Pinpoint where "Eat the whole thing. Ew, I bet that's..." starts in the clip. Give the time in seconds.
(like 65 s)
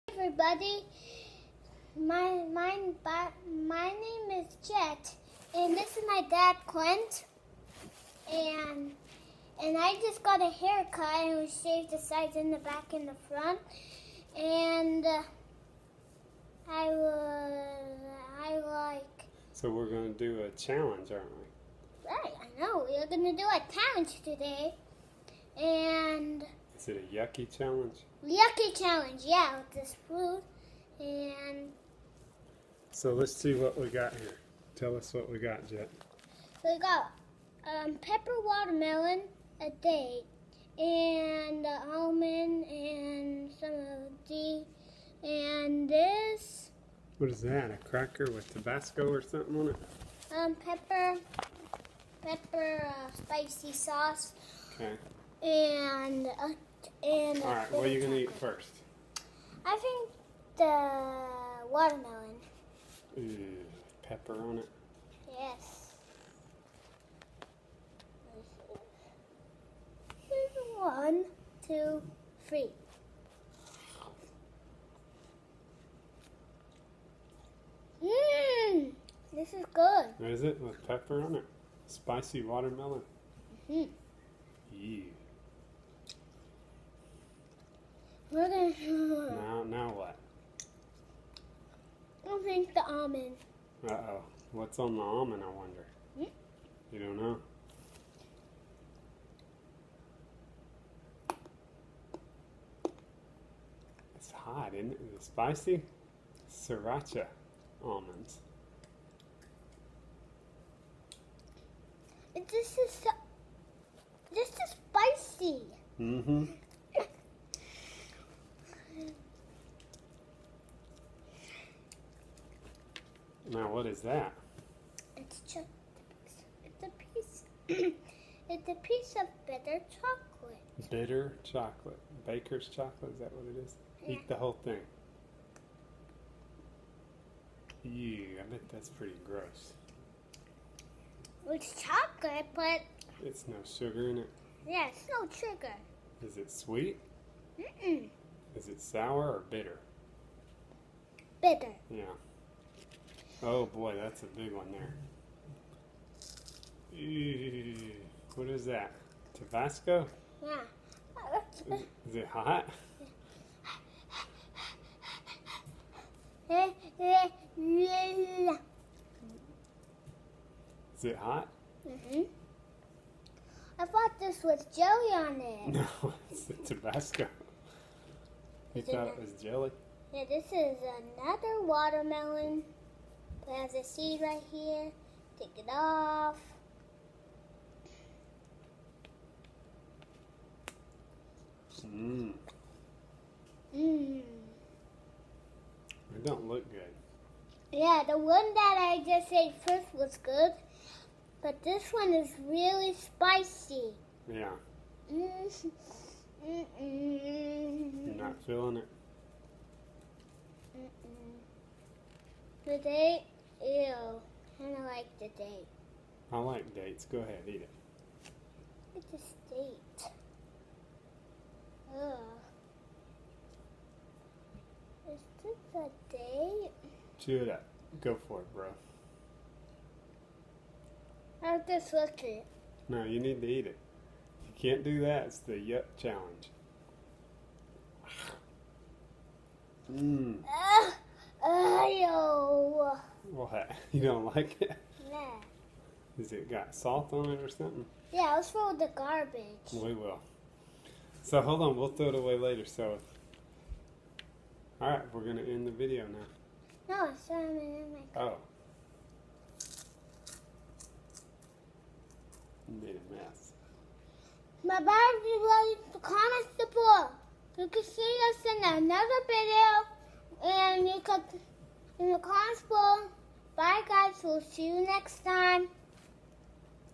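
134 s.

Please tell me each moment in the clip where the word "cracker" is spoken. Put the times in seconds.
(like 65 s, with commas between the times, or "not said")
47 s.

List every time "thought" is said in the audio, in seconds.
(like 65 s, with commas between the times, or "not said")
173 s, 178 s.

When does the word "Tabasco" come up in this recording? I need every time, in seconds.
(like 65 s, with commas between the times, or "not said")
48 s, 159 s, 176 s.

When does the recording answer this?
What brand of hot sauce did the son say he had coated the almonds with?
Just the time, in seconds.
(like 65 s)
106 s.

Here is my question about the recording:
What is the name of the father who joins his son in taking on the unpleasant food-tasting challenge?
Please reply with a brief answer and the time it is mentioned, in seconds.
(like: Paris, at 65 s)
Clint, at 6 s.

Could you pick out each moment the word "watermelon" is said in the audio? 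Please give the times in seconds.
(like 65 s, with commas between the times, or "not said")
38 s, 61 s, 82 s, 181 s.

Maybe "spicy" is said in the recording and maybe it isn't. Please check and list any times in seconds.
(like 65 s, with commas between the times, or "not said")
53 s, 81 s, 105 s, 114 s, 202 s.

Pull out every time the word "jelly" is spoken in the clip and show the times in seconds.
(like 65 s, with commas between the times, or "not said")
174 s, 179 s.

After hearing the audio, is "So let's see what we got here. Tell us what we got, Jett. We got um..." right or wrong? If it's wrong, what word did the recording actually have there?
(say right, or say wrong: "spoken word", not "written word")
right.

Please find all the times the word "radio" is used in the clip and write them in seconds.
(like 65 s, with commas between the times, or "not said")
not said.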